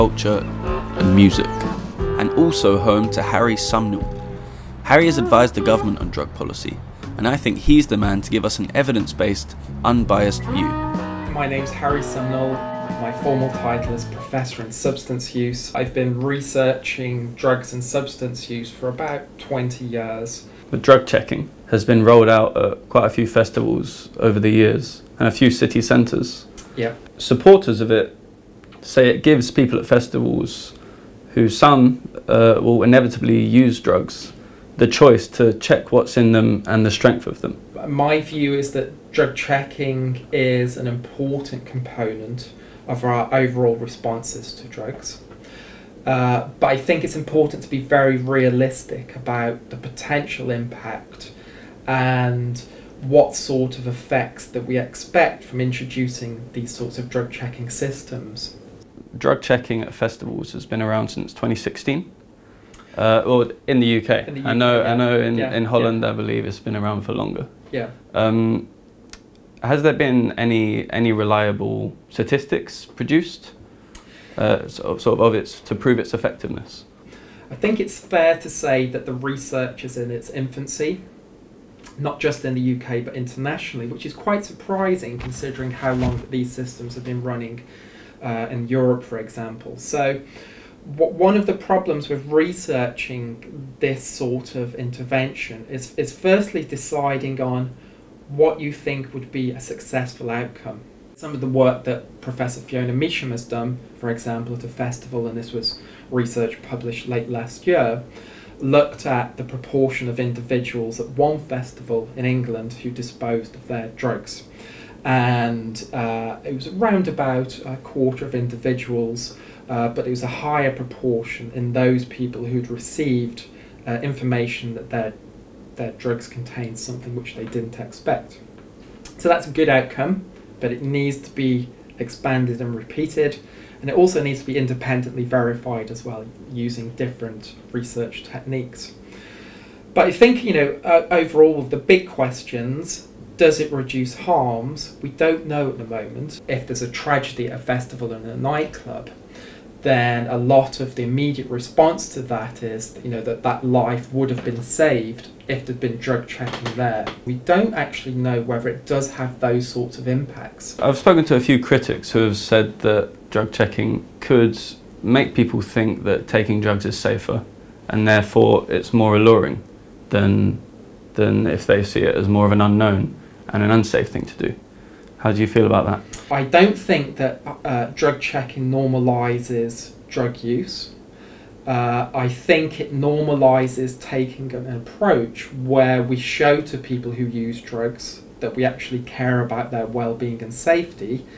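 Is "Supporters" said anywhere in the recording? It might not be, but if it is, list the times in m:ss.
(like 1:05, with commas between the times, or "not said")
0:27.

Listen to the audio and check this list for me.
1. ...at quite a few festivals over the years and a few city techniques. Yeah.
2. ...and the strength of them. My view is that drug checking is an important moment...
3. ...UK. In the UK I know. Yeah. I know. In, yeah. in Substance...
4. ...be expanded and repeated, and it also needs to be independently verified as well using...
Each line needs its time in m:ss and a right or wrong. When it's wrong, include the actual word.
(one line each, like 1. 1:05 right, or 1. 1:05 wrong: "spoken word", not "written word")
1. 0:22 wrong: "centres", not "techniques"
2. 0:36 wrong: "component", not "moment"
3. 1:03 wrong: "Holland", not "Substance"
4. 2:11 right.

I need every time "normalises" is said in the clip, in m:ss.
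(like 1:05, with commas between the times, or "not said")
2:58, 3:02.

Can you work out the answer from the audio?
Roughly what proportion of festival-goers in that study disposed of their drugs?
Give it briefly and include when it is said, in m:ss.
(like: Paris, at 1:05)
a quarter, at 1:57.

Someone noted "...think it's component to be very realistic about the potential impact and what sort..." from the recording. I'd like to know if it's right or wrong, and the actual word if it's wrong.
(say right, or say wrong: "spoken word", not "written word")
wrong: "important", not "component".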